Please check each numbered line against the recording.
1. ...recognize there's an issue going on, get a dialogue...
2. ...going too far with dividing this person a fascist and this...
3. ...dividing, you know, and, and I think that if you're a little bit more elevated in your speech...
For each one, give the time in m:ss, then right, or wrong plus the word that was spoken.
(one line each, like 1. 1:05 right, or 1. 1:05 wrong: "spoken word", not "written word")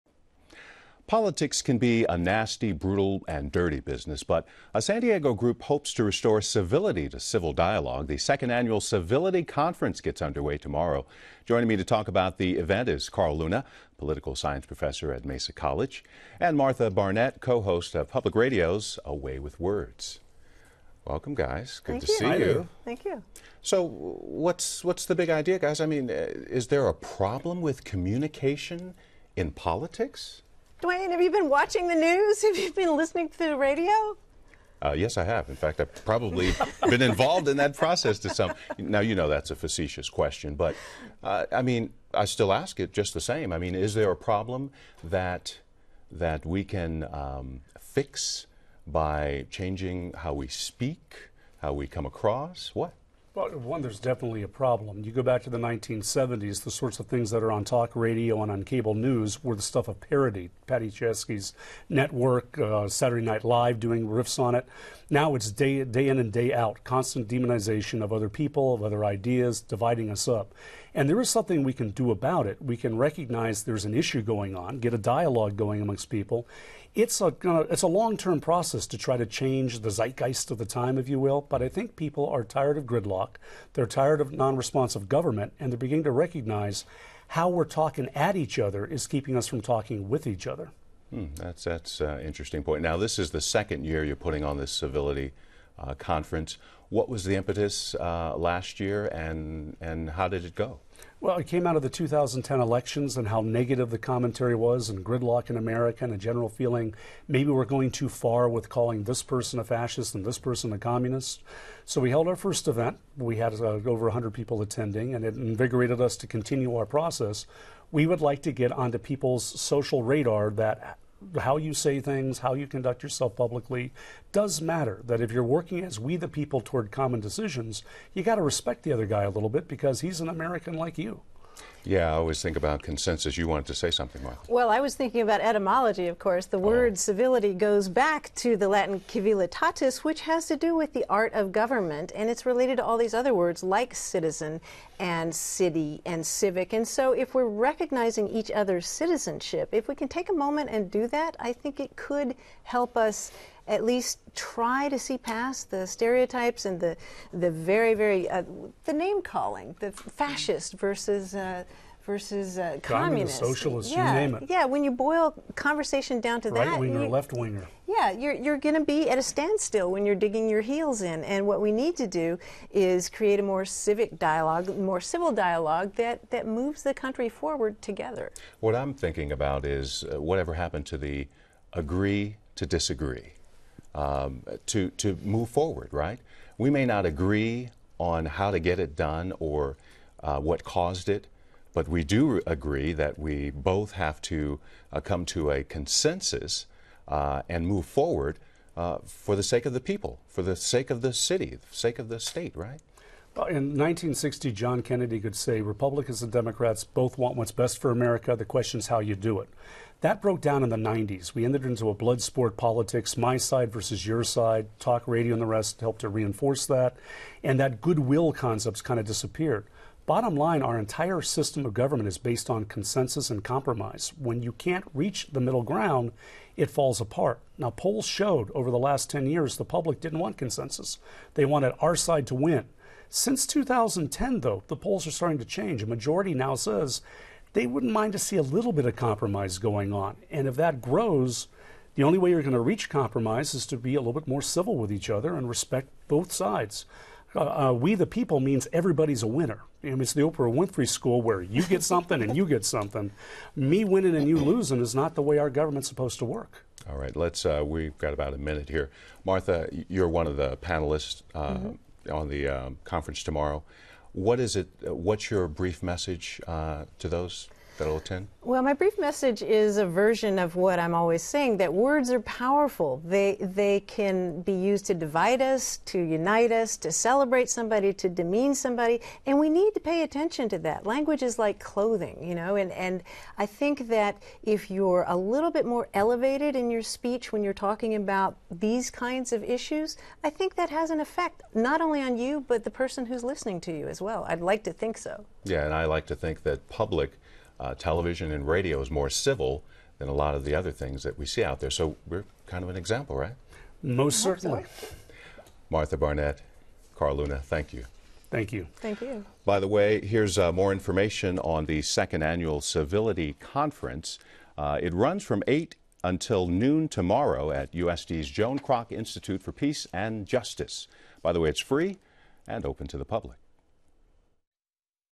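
1. 1:12 right
2. 1:47 wrong: "calling", not "dividing"
3. 4:41 wrong: "clothing", not "dividing".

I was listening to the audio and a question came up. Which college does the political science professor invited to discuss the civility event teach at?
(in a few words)
Mesa College.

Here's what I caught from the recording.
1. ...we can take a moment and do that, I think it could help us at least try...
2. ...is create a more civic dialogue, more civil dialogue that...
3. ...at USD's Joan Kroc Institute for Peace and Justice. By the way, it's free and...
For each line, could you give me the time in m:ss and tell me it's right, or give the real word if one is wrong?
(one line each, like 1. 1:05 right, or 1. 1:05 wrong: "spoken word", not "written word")
1. 2:29 right
2. 2:52 right
3. 5:17 right.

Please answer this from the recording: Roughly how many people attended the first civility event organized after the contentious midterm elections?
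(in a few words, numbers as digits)
over 100.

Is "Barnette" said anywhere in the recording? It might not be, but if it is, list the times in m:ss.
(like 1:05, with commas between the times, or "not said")
0:16, 5:05.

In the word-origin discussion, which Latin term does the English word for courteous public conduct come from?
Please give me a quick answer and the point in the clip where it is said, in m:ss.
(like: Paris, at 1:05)
civilitatis, at 2:19.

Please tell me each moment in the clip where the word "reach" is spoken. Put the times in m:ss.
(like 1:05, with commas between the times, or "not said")
3:44, 4:02.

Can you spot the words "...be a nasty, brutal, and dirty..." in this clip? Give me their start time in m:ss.
0:01.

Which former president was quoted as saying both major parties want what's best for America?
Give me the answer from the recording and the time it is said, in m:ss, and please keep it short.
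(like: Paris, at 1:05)
John Kennedy, at 3:24.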